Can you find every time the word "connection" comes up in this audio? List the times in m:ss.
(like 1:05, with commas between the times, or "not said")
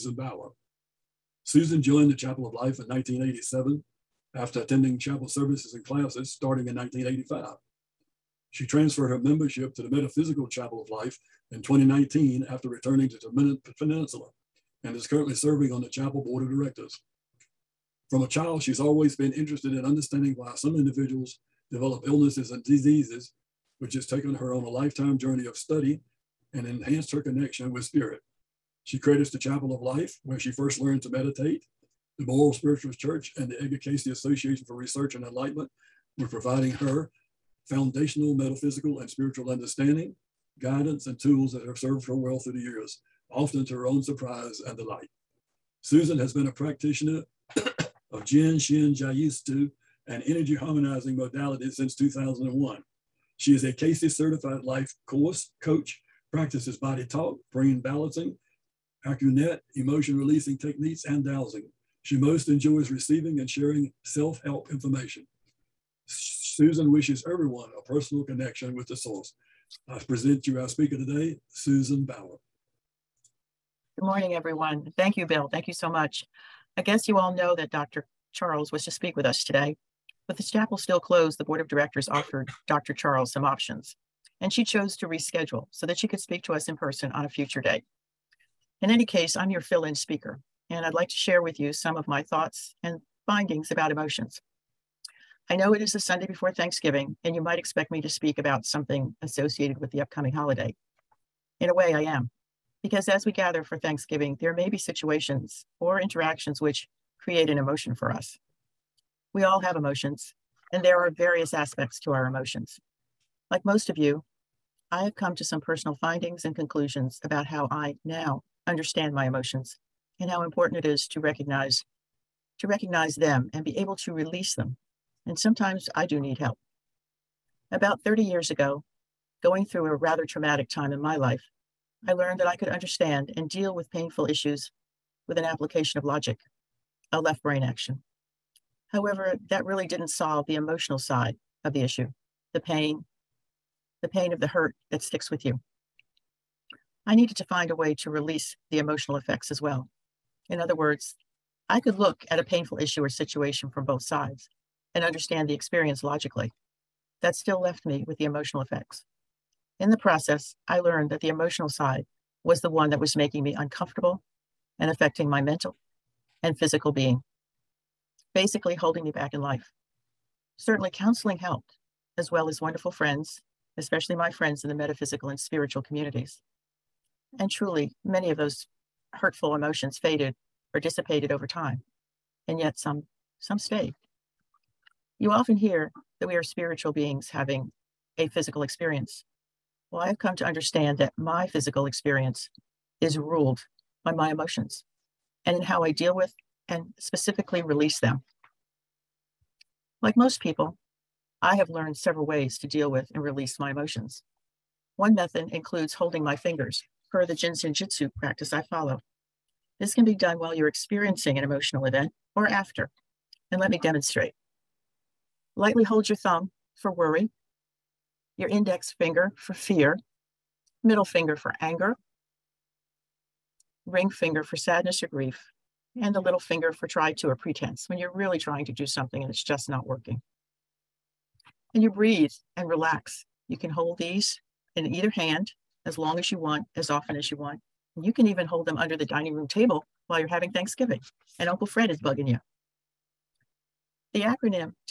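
0:27, 1:08.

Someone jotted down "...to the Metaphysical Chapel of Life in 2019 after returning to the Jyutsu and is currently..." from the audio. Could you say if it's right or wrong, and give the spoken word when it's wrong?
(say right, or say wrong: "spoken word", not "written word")
wrong: "Peninsula", not "Jyutsu".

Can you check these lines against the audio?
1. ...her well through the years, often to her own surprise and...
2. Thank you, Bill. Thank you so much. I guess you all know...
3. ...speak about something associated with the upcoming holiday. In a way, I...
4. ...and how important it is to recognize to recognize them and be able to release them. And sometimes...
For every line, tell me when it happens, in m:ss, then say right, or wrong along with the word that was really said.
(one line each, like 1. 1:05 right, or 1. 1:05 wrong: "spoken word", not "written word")
1. 0:42 right
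2. 1:14 right
3. 1:38 right
4. 2:00 right.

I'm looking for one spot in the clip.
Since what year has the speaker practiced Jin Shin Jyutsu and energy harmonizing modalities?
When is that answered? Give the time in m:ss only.
0:51.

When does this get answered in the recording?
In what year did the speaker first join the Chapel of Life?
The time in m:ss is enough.
0:02.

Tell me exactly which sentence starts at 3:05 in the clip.
You often hear that we are spiritual beings having a physical experience.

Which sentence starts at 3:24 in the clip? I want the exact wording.
One method includes holding my fingers, per the Jin Shin Jyutsu practice I follow.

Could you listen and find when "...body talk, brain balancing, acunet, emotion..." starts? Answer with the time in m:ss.
0:56.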